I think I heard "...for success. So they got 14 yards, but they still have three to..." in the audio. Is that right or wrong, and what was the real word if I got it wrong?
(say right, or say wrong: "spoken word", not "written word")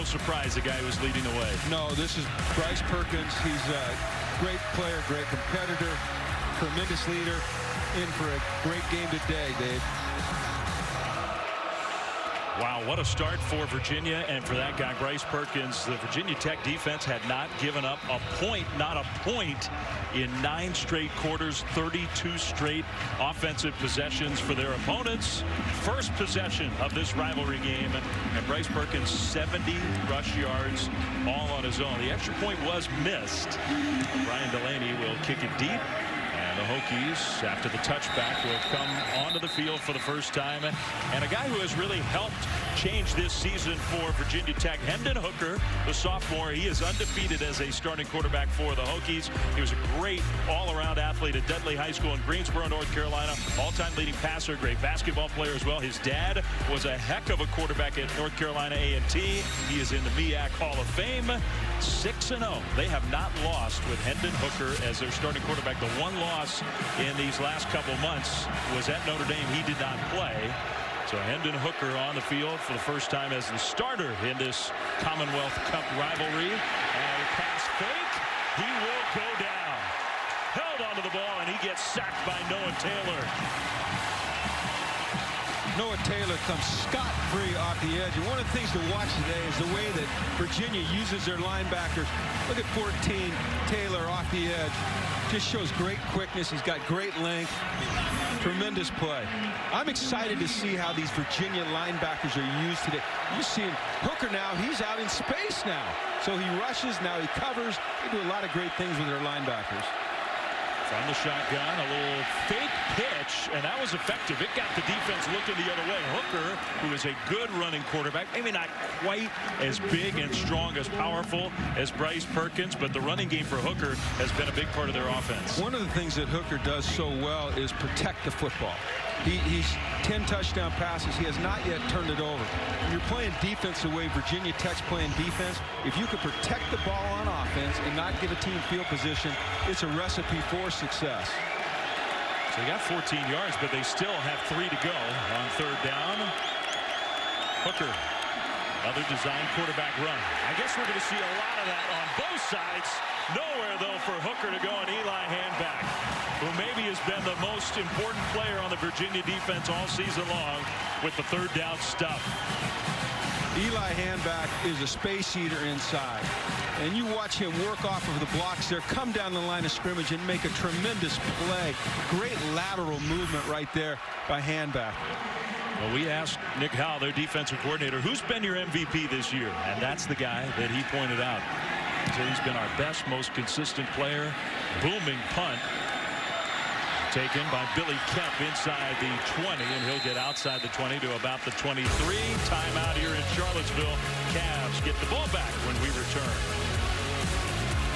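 right.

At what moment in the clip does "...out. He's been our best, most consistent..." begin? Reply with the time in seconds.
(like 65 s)
181 s.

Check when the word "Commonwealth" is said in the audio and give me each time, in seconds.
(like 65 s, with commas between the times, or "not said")
74 s.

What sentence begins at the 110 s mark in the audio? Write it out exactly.
From the shotgun, a little fake pitch, and that was effective.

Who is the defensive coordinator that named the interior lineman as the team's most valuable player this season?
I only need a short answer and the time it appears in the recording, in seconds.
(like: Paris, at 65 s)
Nick Howell, at 176 s.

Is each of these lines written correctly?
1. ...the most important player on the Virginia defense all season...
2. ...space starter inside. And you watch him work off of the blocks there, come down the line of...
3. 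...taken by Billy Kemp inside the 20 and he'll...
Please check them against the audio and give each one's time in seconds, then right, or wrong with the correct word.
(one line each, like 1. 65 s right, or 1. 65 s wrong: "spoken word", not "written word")
1. 157 s right
2. 164 s wrong: "eater", not "starter"
3. 187 s right.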